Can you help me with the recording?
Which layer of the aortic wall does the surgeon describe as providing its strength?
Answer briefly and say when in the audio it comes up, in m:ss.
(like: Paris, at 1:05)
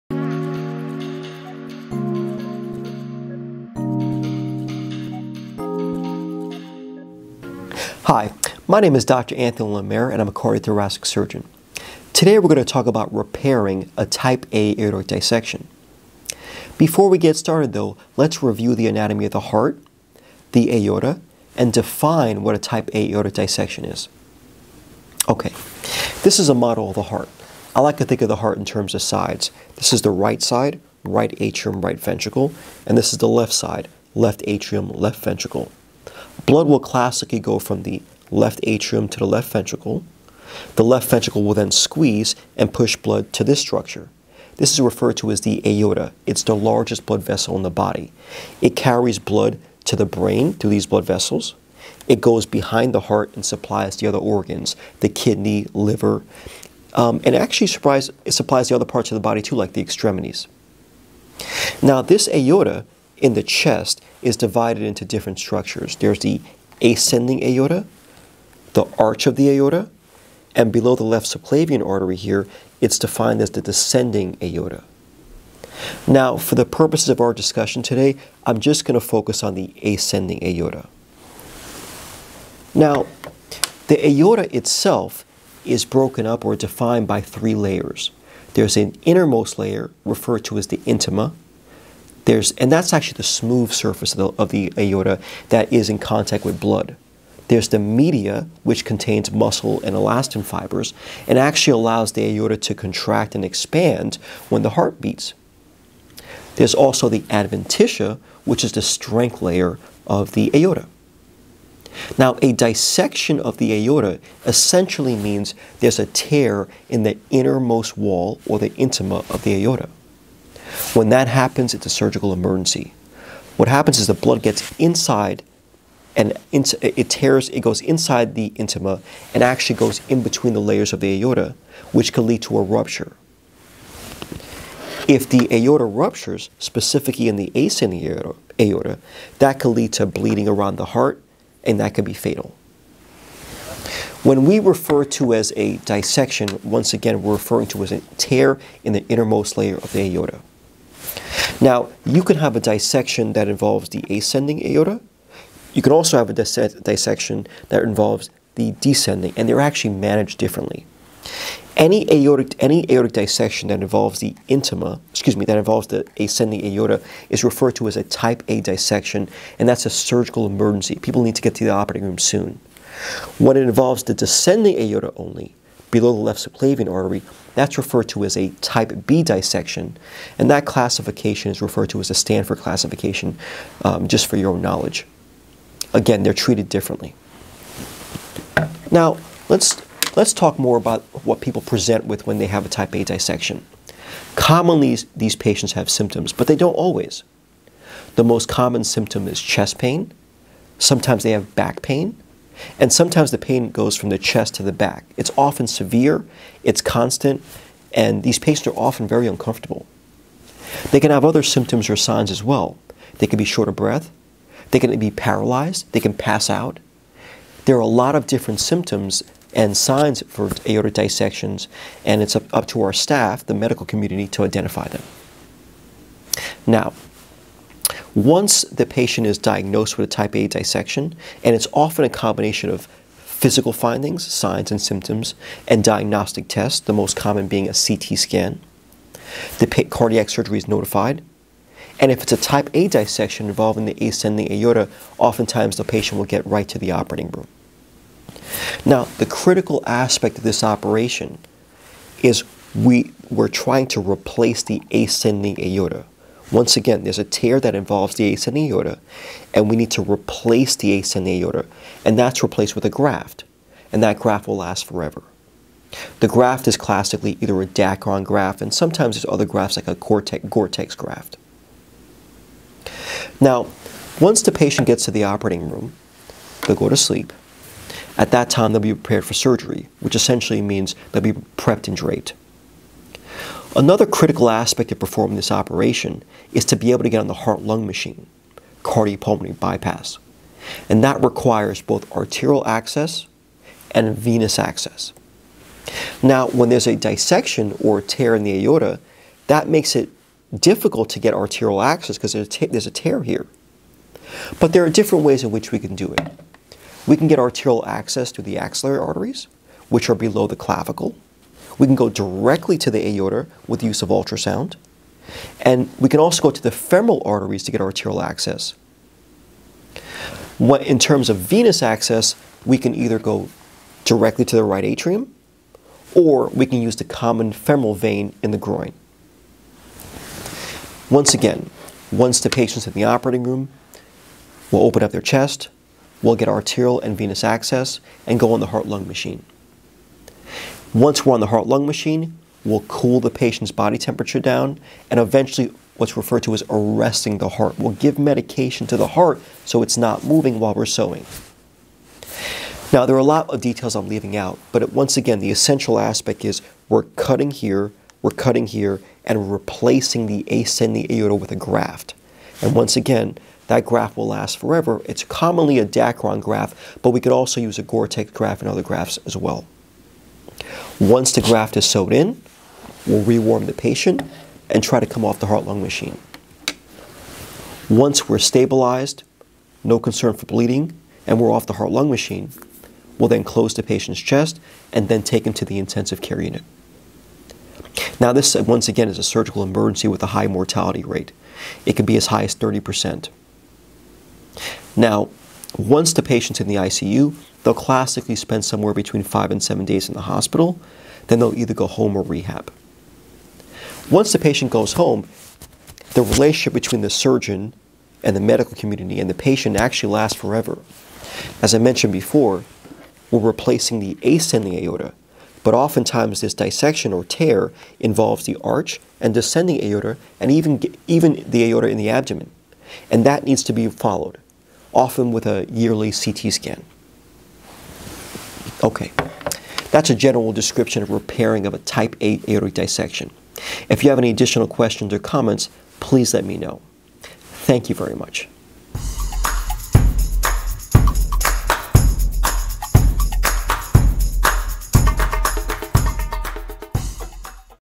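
adventitia, at 1:47.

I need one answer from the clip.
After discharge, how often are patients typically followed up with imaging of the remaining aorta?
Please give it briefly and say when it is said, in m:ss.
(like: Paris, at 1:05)
yearly, at 7:05.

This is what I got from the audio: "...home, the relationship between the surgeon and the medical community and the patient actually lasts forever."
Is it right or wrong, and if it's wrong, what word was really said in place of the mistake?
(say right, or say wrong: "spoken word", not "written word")
right.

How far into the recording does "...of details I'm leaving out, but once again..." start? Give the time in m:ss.
5:53.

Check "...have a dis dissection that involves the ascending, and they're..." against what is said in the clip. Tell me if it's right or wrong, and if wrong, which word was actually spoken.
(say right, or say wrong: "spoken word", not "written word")
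wrong: "descending", not "ascending".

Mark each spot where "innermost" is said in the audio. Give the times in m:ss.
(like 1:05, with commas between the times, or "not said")
1:29, 1:57, 2:29.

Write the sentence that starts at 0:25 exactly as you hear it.
Okay, this is a model of the heart.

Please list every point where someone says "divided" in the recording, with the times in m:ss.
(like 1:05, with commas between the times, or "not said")
1:04.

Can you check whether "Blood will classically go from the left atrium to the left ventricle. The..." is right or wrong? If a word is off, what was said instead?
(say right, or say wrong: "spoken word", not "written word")
right.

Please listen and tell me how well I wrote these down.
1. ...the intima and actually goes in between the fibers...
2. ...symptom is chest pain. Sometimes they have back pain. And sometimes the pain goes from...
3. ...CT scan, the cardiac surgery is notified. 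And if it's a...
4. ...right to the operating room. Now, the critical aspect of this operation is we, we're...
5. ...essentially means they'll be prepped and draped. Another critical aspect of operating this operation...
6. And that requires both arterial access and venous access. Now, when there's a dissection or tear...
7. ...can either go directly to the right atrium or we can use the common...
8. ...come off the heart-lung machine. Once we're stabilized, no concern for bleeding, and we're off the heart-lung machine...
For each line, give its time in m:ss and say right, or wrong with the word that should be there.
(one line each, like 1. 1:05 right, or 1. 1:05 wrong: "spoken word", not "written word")
1. 2:08 wrong: "layers", not "fibers"
2. 3:18 right
3. 3:57 right
4. 4:06 right
5. 4:40 wrong: "performing", not "operating"
6. 4:50 right
7. 5:22 right
8. 6:15 right.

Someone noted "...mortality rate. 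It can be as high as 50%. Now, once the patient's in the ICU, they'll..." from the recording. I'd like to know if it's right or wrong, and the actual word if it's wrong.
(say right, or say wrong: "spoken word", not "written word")
wrong: "30", not "50".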